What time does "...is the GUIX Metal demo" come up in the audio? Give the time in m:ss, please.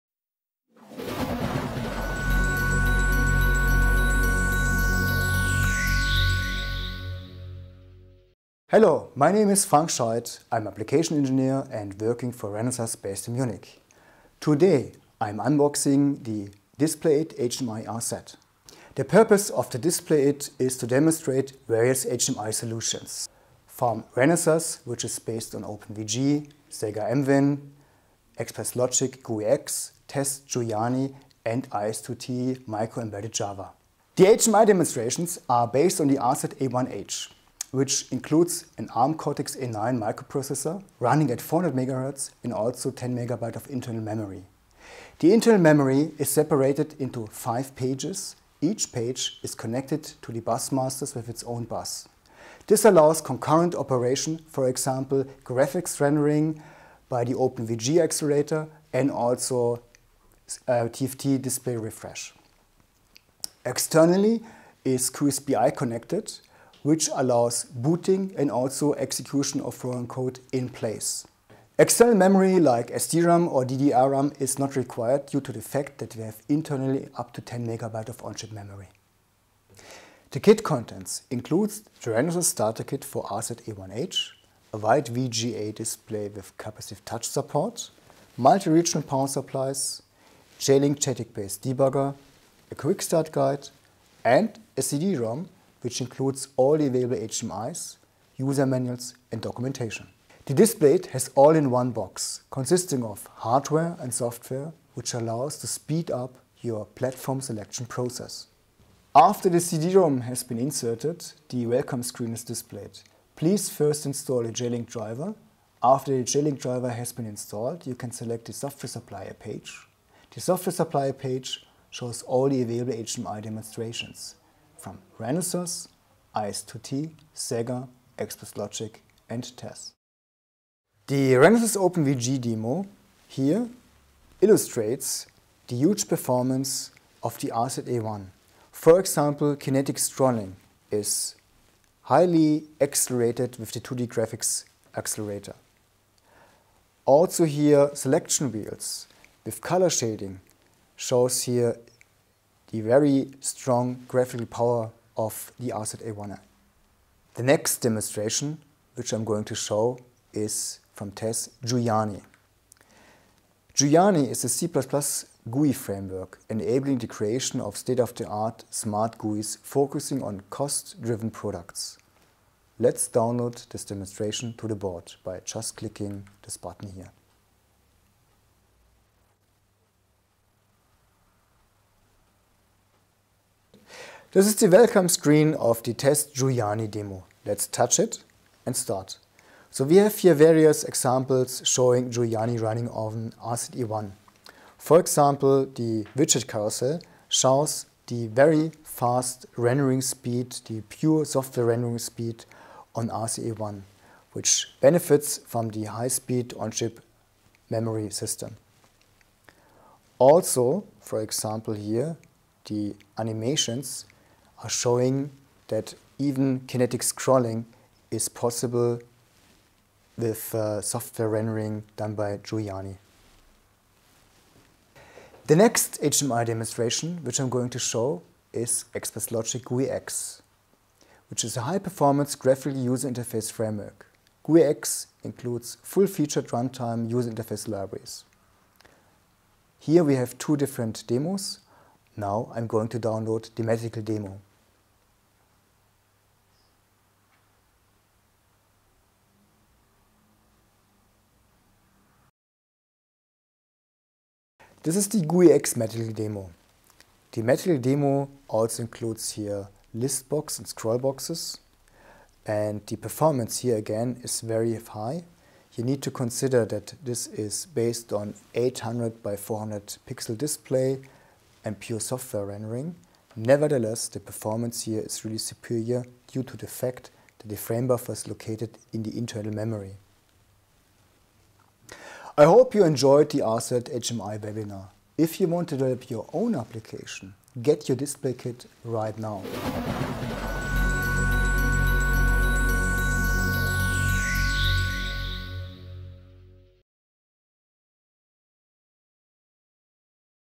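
4:14.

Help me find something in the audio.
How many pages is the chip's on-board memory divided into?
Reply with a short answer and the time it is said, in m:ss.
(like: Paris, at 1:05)
5, at 0:47.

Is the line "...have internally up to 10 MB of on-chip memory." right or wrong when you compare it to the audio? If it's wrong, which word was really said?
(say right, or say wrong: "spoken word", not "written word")
right.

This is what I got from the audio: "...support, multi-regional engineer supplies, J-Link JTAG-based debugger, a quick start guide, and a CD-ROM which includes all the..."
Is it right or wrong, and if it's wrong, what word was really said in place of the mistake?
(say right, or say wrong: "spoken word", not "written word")
wrong: "power", not "engineer".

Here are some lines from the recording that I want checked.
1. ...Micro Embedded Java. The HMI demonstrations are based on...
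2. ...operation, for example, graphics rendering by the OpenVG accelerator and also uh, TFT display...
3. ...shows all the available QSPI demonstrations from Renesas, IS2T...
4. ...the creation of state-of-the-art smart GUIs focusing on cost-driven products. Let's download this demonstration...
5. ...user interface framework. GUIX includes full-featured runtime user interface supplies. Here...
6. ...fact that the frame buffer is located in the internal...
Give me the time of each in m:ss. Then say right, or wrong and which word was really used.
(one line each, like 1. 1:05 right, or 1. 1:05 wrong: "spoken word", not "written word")
1. 0:32 right
2. 0:53 right
3. 2:01 wrong: "HMI", not "QSPI"
4. 2:46 right
5. 3:52 wrong: "libraries", not "supplies"
6. 4:36 right.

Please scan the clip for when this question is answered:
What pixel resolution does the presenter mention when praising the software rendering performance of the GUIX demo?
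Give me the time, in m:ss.
4:28.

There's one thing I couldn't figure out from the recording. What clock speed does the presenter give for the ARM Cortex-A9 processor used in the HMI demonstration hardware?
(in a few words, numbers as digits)
400 MHz.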